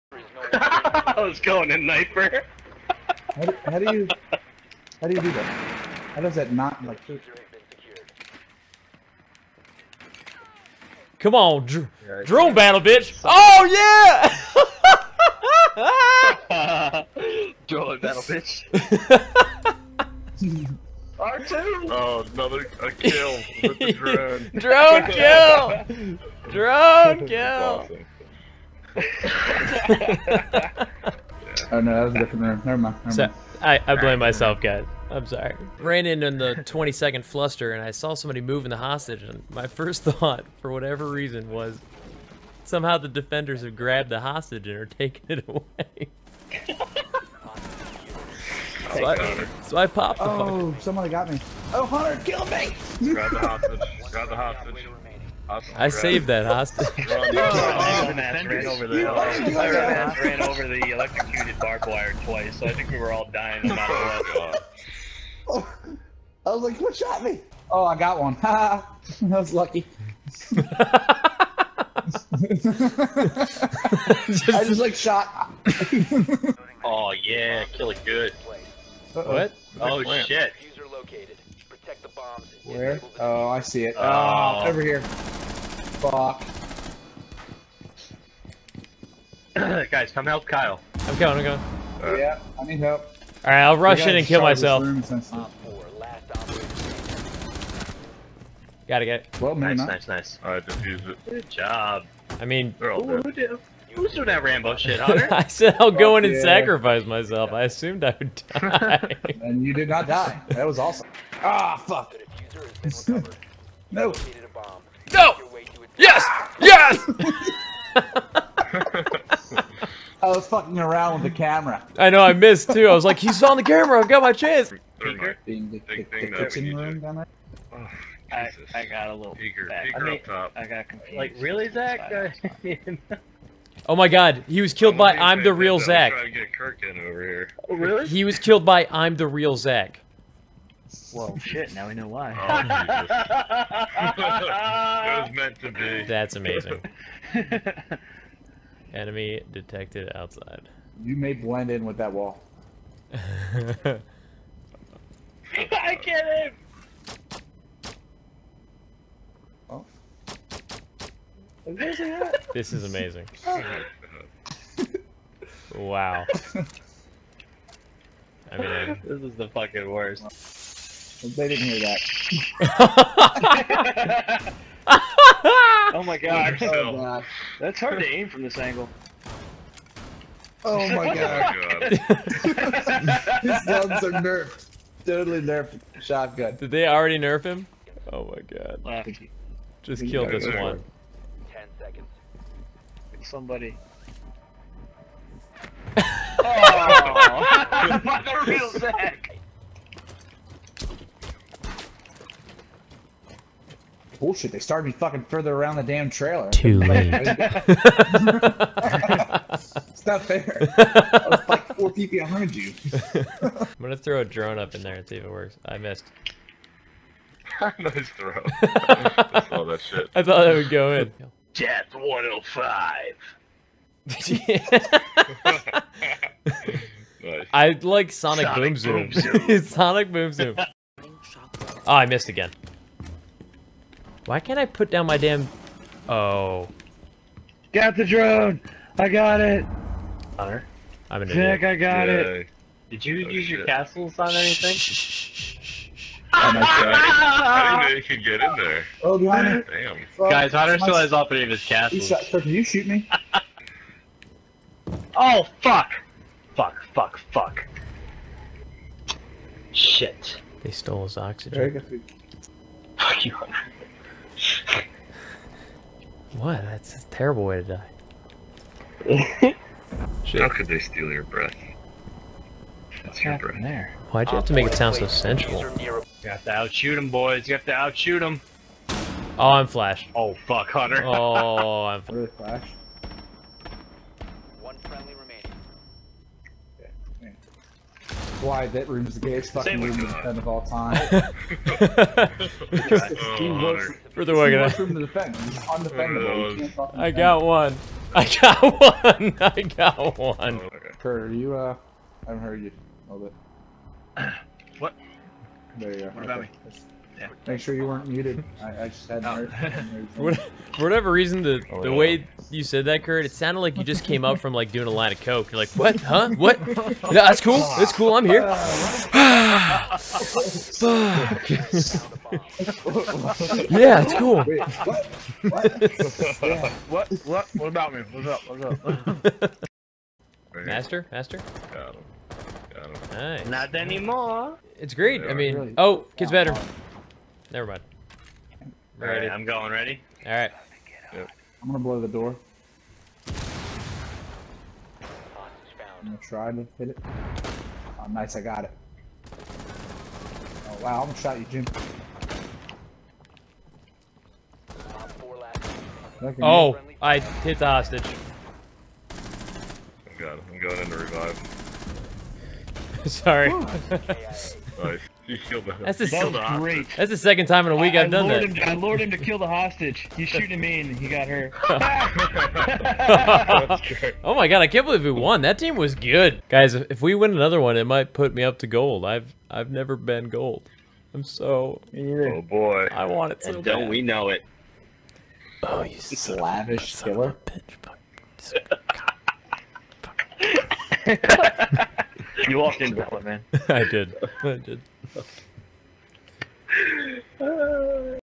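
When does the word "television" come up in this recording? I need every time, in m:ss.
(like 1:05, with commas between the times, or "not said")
not said.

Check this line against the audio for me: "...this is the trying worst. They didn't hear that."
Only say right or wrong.
wrong.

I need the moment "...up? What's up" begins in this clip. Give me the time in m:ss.
5:28.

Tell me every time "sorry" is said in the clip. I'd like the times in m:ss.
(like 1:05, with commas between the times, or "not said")
0:35, 6:03.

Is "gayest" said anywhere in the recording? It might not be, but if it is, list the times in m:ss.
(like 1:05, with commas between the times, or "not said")
4:49.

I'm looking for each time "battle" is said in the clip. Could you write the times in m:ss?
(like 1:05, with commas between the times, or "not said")
0:12, 0:17.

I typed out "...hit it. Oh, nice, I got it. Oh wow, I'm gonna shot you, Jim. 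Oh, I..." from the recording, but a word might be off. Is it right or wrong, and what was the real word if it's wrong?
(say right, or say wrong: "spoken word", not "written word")
right.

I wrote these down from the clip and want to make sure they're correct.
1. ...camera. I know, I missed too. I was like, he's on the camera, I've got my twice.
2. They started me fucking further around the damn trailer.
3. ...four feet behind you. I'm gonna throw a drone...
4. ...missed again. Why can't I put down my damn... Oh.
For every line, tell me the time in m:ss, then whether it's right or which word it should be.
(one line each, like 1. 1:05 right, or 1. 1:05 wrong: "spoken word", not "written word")
1. 2:01 wrong: "chance", not "twice"
2. 3:24 right
3. 3:31 right
4. 3:52 right.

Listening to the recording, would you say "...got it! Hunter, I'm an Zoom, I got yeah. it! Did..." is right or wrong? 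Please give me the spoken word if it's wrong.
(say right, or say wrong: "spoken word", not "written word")
wrong: "Nick", not "Zoom".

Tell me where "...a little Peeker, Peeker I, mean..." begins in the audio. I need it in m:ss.
2:09.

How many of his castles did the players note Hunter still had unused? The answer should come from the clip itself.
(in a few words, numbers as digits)
3.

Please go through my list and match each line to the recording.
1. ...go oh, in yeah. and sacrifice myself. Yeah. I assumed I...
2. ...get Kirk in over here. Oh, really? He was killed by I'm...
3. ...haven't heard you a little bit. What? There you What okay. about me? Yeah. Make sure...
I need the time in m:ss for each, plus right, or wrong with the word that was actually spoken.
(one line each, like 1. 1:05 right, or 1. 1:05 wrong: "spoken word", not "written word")
1. 1:45 right
2. 2:16 right
3. 5:02 right.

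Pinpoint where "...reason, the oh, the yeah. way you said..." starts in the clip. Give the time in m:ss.
5:11.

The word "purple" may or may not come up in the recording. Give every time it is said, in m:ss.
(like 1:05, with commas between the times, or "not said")
not said.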